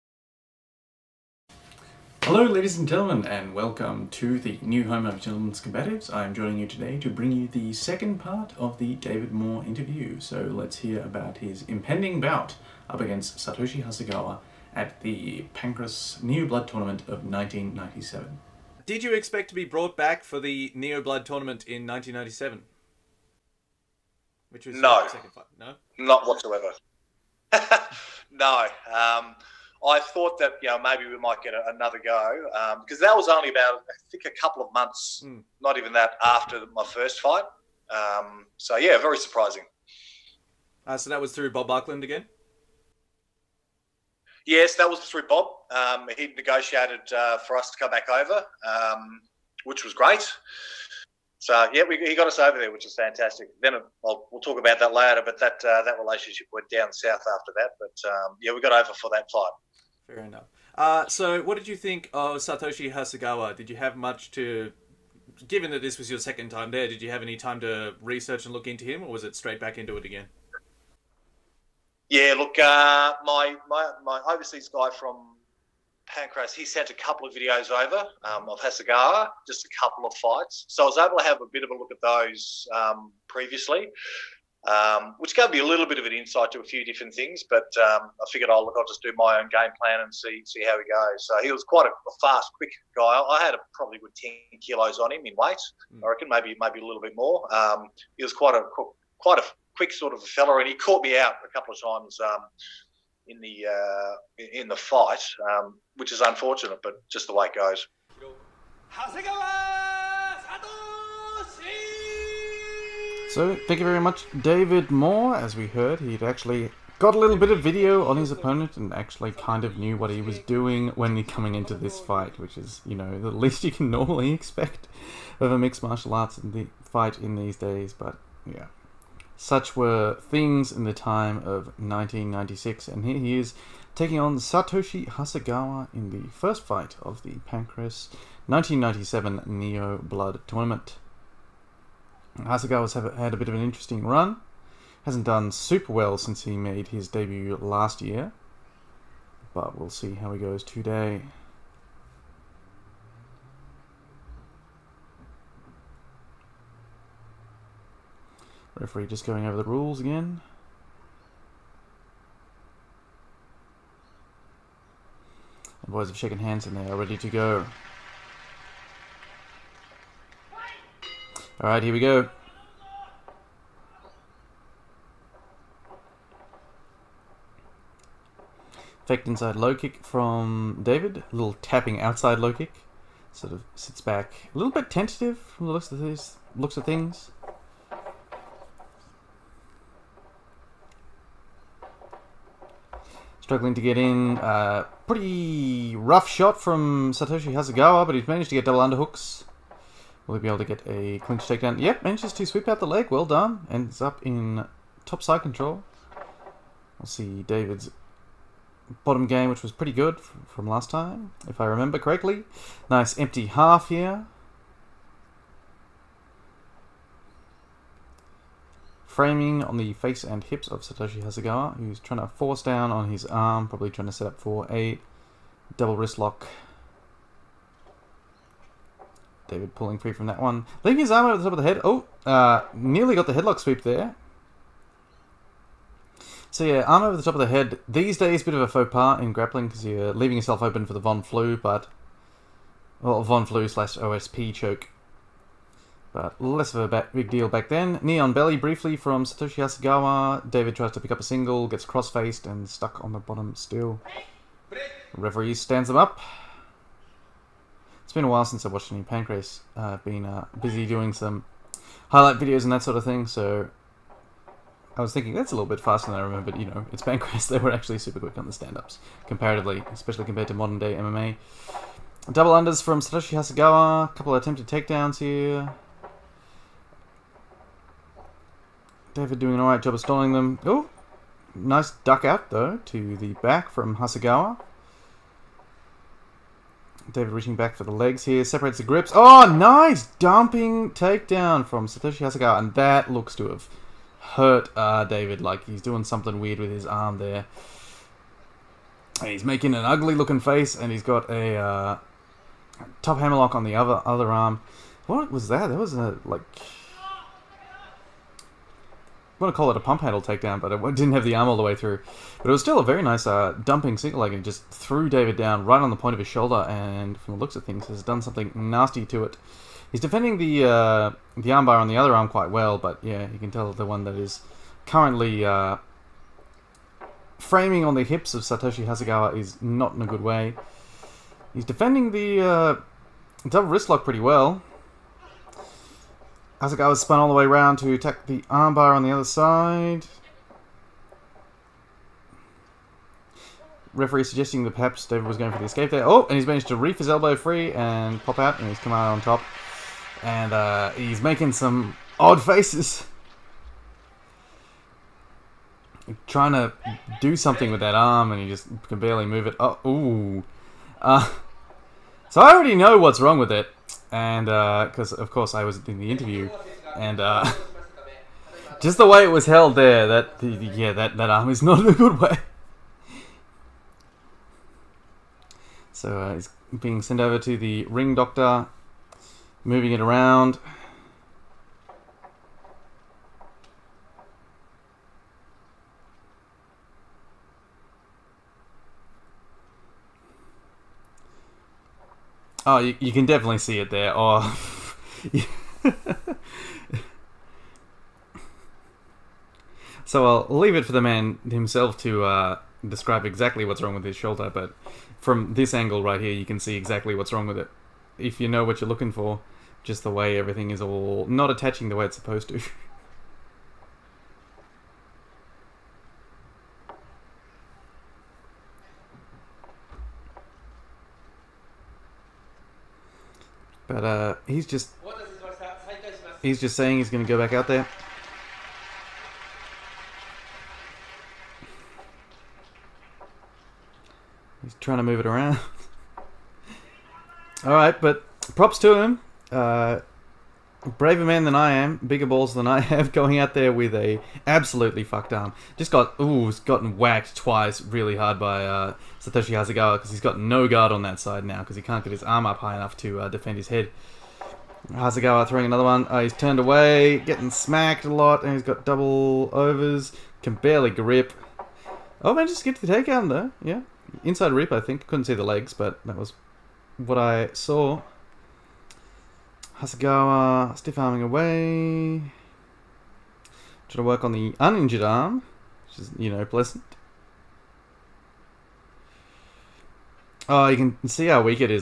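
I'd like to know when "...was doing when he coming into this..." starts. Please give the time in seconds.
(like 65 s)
120 s.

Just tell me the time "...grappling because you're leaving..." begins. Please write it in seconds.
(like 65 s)
239 s.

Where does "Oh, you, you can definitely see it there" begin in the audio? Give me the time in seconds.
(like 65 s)
392 s.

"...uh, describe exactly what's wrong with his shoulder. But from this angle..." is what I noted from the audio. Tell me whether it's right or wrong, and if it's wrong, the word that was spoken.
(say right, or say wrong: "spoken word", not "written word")
right.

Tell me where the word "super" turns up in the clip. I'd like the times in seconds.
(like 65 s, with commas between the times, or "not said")
145 s, 267 s.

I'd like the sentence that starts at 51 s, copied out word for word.
So yeah, we, he got us over there, which is fantastic.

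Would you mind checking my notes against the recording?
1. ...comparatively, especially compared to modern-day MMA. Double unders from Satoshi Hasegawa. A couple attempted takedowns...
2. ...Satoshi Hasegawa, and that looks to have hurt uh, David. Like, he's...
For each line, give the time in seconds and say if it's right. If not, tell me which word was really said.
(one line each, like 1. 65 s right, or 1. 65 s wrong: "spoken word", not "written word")
1. 269 s right
2. 291 s right.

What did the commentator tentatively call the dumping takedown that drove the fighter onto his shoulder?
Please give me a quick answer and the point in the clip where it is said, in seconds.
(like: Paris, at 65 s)
pump handle takedown, at 309 s.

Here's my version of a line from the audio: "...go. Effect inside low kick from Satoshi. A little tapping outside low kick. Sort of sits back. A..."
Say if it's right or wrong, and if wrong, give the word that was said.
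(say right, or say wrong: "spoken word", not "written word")
wrong: "David", not "Satoshi".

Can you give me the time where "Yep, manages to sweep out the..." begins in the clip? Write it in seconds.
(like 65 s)
201 s.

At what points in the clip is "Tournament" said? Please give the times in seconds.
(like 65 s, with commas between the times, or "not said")
16 s, 21 s, 140 s.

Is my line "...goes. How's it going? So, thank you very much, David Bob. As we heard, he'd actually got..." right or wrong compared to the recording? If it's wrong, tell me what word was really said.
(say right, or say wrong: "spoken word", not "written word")
wrong: "Moore", not "Bob".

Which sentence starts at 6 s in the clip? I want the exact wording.
I'm joining you today to bring you the second part of the David Moore interview.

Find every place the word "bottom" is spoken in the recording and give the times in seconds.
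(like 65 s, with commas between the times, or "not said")
209 s, 253 s.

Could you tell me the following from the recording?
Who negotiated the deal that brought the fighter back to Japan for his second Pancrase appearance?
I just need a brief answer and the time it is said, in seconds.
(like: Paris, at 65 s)
Bob Buckland, at 41 s.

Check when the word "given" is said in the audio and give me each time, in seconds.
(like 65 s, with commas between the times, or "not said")
65 s.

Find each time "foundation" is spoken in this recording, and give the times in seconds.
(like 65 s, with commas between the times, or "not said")
not said.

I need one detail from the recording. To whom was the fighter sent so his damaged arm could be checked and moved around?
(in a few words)
ring doctor.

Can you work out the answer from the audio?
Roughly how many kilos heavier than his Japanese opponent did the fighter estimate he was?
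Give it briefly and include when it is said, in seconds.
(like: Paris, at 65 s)
10, at 94 s.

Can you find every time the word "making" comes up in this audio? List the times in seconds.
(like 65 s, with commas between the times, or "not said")
299 s, 351 s.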